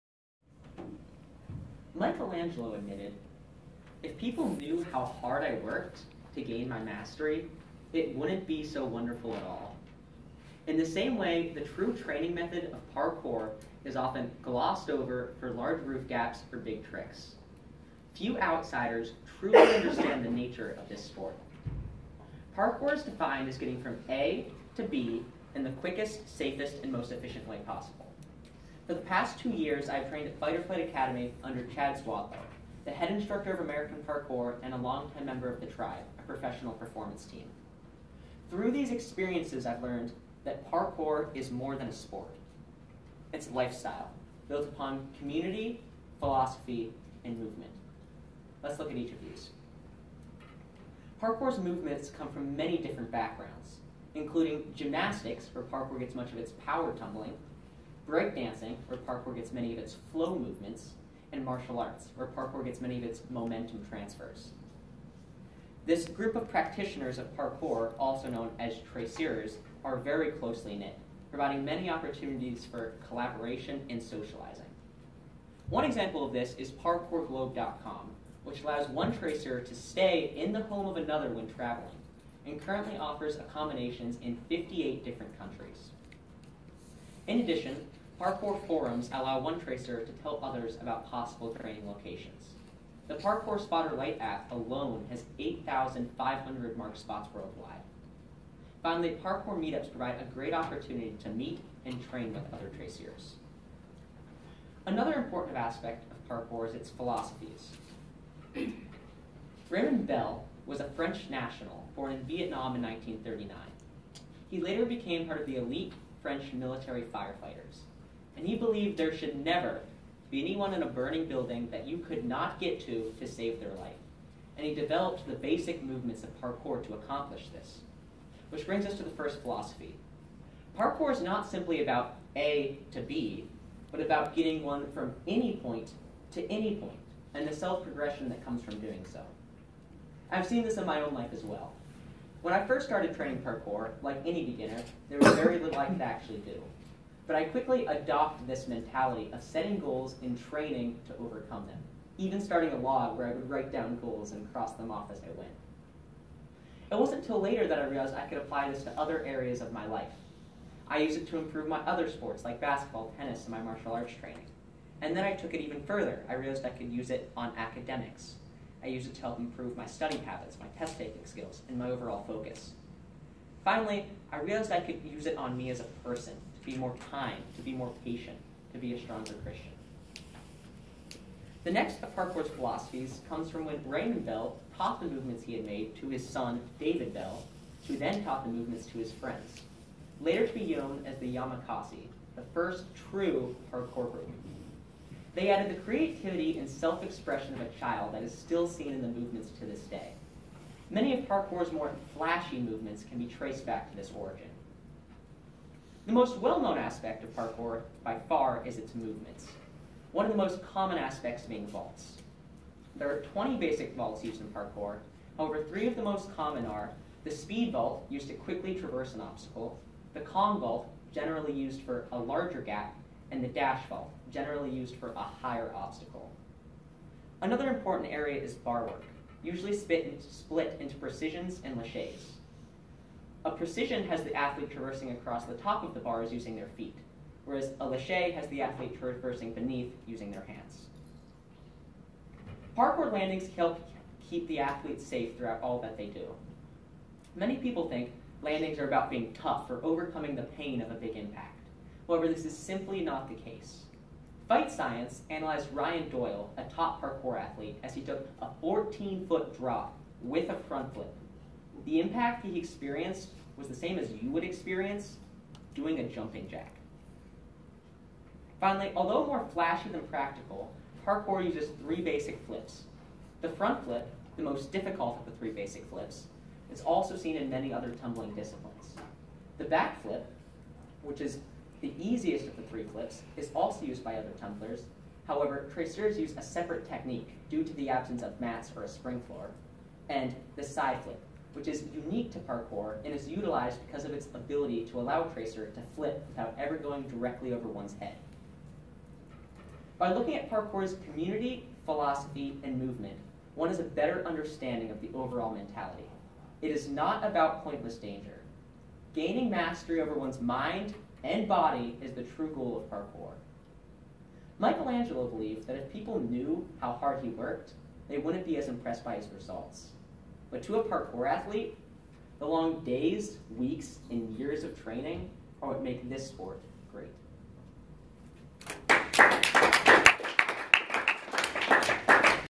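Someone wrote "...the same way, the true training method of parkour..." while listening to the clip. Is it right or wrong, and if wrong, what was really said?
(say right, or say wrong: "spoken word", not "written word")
right.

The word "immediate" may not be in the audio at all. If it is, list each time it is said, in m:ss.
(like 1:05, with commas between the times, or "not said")
not said.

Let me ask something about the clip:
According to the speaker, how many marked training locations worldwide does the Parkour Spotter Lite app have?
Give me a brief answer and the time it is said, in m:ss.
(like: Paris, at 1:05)
8,500, at 1:35.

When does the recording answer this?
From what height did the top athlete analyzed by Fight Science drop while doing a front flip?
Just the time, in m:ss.
4:18.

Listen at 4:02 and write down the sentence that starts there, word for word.
Parkour landings help keep the athletes safe throughout all that they do.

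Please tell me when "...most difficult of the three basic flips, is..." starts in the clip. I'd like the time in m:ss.
4:34.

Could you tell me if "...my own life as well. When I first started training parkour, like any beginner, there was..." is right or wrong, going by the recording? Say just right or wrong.
right.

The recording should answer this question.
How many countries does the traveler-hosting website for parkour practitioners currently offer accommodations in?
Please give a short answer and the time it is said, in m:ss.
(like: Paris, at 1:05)
58, at 1:24.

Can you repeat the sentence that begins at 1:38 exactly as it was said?
Finally, parkour meetups provide a great opportunity to meet and train with other tracers.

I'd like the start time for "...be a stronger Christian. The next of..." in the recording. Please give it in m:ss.
2:58.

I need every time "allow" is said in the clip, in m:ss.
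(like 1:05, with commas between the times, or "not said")
1:18, 1:29, 4:55.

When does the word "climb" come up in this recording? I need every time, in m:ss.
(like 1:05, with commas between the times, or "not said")
not said.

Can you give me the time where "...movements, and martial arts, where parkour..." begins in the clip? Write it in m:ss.
1:00.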